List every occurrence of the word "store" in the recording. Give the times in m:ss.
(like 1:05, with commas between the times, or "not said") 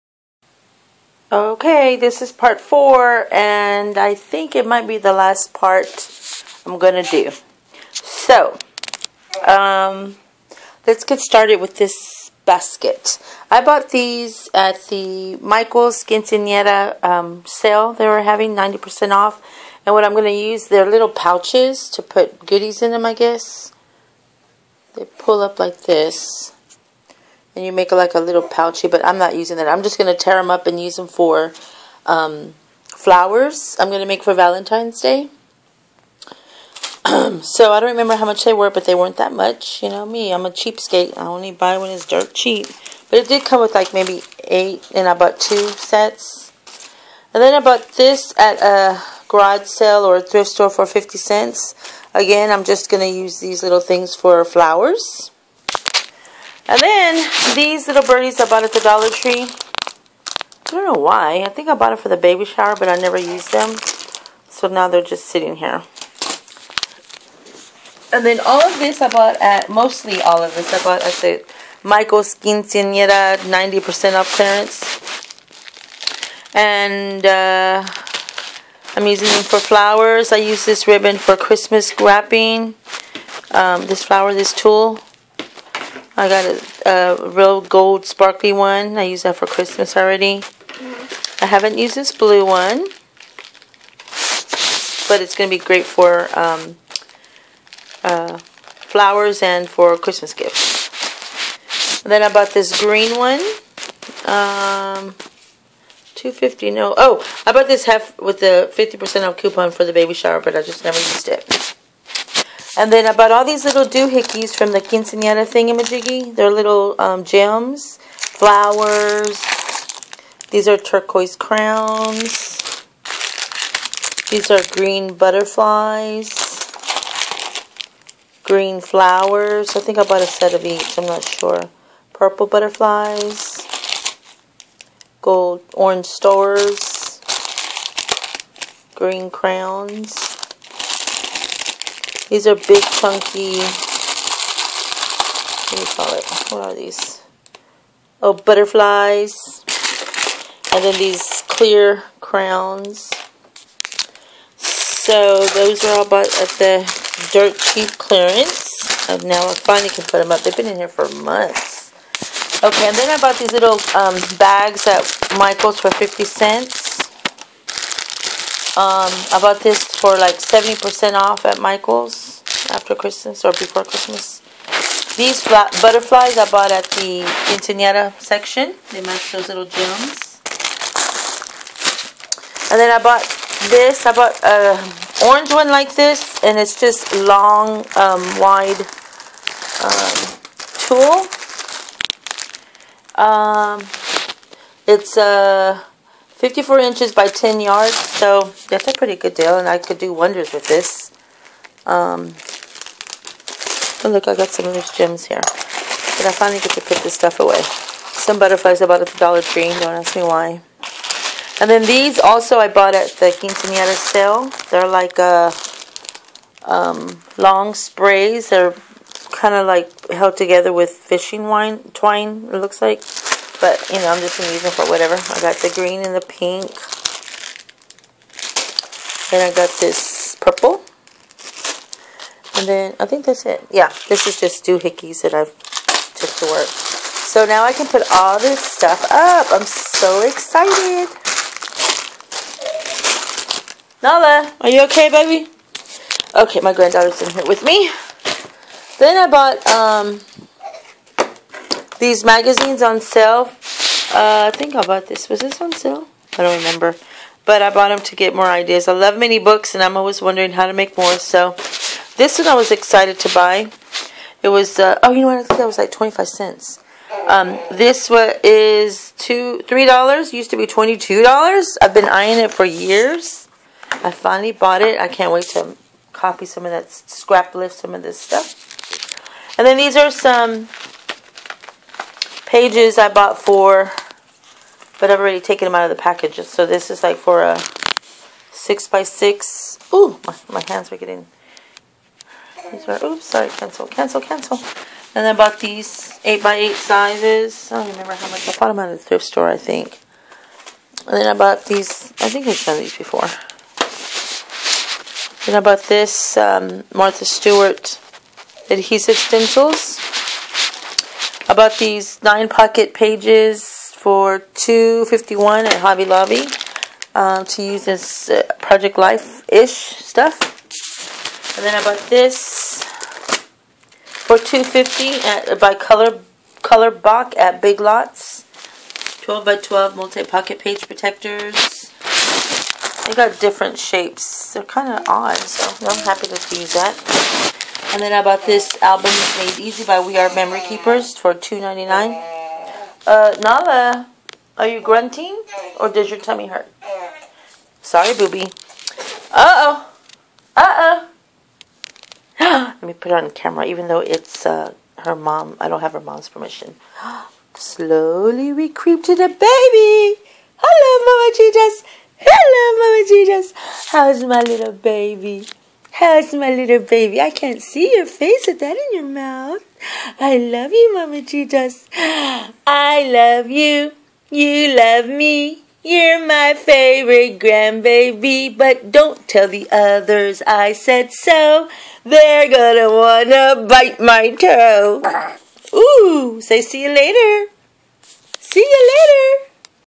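0:50, 4:59.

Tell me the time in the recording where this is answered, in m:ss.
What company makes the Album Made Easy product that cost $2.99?
5:39.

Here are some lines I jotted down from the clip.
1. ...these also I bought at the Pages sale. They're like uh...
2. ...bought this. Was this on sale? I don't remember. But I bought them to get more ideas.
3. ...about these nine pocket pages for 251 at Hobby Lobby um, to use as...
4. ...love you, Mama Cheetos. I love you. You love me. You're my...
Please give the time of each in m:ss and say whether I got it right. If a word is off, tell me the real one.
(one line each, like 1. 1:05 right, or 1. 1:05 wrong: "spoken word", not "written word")
1. 3:31 wrong: "Quinceañera", not "Pages"
2. 4:14 right
3. 5:11 right
4. 6:10 right.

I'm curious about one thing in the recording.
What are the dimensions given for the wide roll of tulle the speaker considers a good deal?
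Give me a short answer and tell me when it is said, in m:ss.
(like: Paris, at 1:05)
54 inches by 10 yards, at 3:16.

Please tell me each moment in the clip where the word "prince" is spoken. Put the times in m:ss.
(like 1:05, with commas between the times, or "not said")
not said.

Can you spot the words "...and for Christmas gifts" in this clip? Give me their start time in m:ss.
1:39.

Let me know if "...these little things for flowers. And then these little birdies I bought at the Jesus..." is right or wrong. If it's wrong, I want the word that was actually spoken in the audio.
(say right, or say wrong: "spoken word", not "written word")
wrong: "Dollar", not "Jesus".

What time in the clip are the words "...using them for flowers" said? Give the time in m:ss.
1:19.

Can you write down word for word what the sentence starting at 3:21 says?
Um, oh look, I got some of these gems here.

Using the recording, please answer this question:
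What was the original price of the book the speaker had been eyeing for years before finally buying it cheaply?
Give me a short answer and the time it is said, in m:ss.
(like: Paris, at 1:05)
$22, at 4:30.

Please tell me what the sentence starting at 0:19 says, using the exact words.
And what I'm going to use, they're little pouches to put goodies in them, I guess.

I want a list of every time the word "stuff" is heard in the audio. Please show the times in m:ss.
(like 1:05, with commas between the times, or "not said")
3:27, 3:58, 4:38, 5:19.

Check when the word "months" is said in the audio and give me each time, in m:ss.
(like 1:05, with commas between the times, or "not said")
2:41.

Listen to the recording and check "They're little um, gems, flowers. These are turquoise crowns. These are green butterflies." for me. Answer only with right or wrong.
right.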